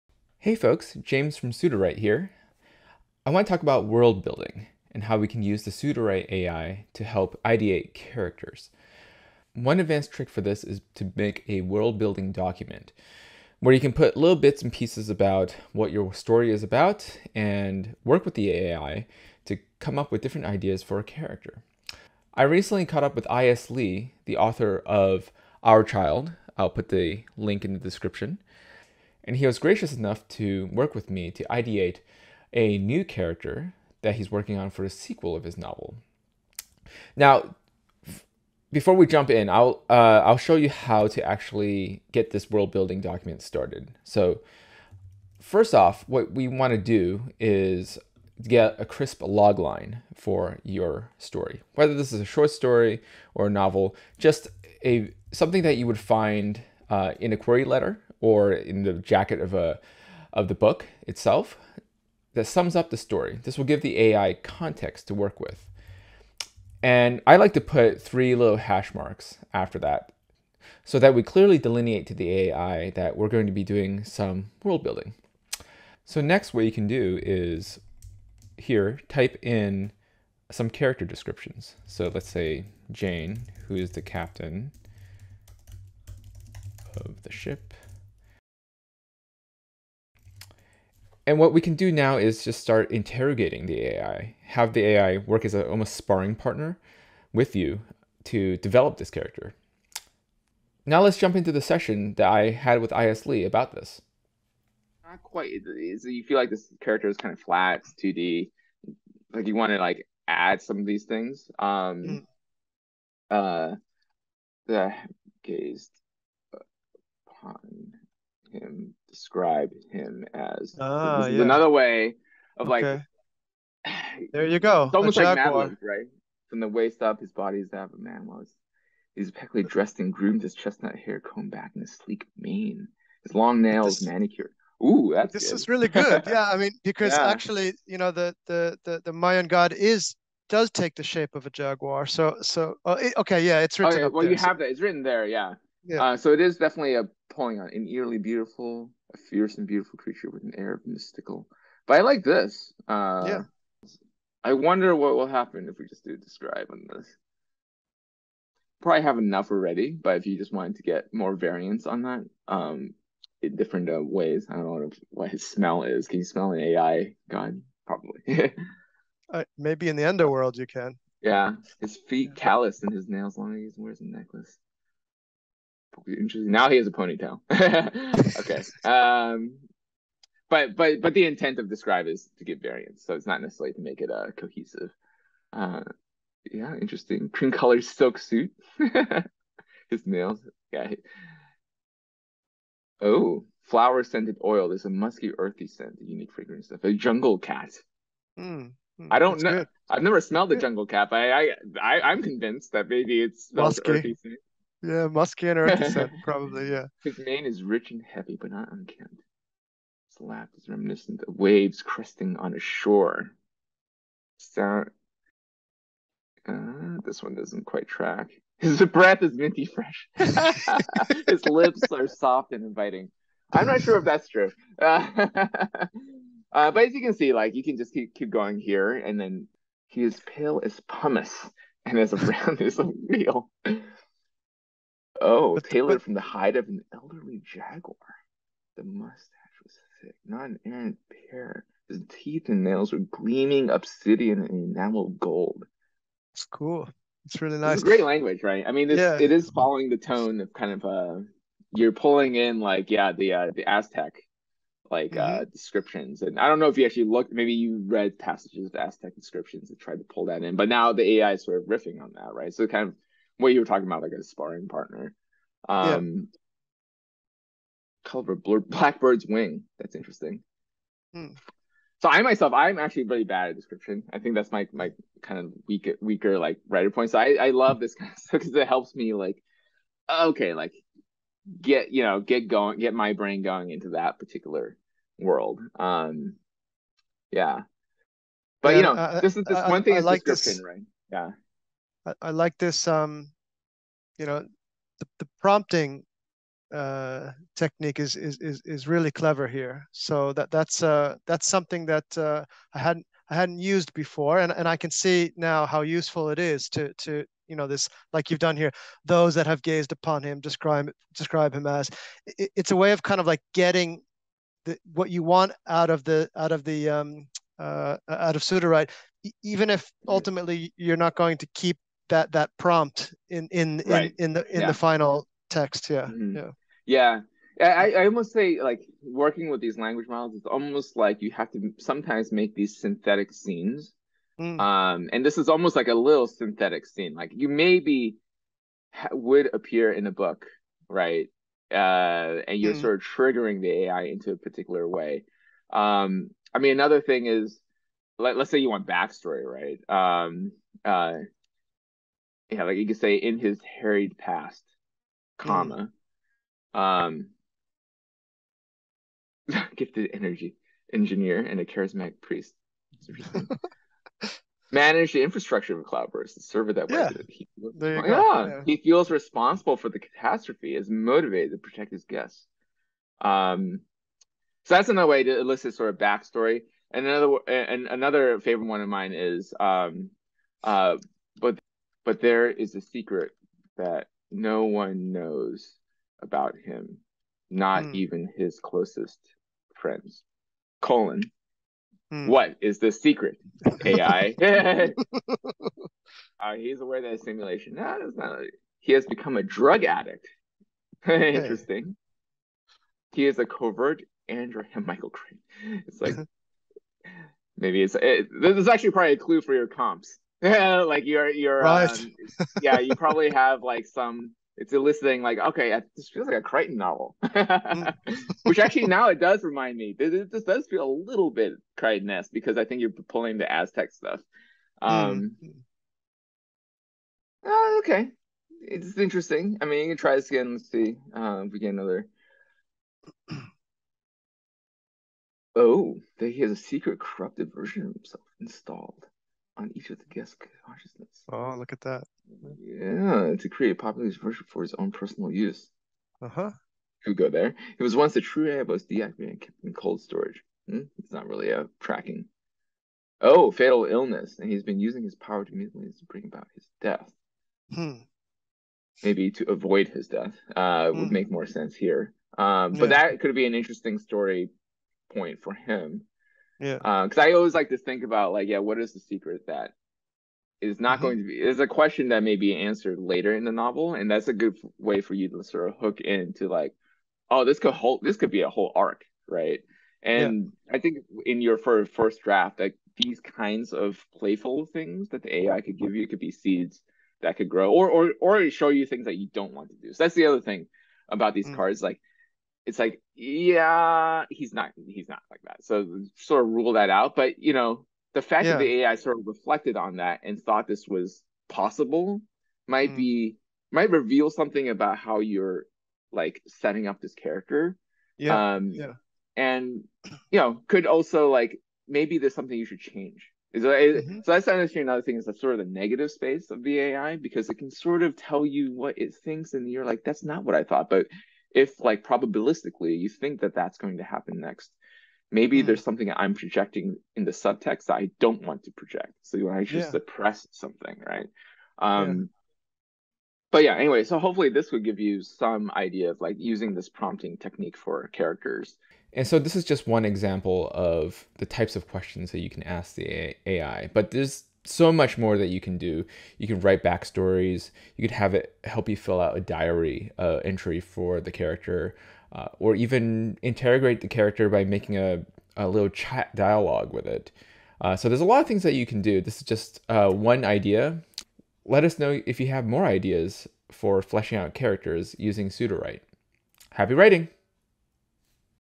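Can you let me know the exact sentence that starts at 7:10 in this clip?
Let's see uh, if we get another.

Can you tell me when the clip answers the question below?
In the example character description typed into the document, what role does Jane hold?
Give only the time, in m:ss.
1:24.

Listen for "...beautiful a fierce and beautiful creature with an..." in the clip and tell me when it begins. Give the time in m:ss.
2:28.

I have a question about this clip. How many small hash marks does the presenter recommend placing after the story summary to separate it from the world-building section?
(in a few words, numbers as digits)
3.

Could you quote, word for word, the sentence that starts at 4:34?
I think that's my my kind of weak weaker like writer point.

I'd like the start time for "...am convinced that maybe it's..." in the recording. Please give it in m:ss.
3:22.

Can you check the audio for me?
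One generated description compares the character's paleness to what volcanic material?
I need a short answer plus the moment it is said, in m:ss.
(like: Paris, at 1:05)
Pumice, at 3:50.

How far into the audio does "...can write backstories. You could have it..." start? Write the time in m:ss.
9:06.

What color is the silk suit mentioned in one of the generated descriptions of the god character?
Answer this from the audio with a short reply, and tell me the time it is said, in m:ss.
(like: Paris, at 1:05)
Cream, at 3:07.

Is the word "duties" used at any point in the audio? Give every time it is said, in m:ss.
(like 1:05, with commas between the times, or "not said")
not said.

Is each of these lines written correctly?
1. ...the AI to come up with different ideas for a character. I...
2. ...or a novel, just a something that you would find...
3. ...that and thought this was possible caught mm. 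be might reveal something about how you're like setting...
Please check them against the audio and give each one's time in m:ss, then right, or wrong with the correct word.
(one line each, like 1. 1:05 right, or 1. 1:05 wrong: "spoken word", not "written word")
1. 0:18 right
2. 0:53 right
3. 8:19 wrong: "might", not "caught".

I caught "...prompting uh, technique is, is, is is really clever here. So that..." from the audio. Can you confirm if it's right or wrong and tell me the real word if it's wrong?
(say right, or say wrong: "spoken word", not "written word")
right.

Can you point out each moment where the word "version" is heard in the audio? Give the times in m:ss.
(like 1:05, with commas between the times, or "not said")
7:17, 7:24.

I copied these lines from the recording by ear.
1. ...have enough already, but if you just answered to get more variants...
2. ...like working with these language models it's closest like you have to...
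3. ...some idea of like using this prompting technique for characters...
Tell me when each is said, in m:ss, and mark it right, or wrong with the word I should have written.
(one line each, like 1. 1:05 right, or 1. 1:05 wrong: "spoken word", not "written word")
1. 2:39 wrong: "wanted", not "answered"
2. 5:28 wrong: "almost", not "closest"
3. 8:55 right.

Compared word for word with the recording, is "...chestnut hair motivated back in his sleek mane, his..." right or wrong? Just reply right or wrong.
wrong.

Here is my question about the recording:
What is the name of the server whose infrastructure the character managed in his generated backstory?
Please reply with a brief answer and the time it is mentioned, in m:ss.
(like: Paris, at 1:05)
Cloudburst, at 6:05.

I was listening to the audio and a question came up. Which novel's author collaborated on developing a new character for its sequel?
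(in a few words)
Aur Child.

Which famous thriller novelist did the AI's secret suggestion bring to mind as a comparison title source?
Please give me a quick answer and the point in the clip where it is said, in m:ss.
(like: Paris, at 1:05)
Michael Crichton, at 6:44.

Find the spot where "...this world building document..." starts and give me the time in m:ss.
0:42.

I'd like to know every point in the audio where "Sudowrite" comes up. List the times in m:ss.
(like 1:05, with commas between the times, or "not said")
0:01, 0:05, 5:18, 9:25.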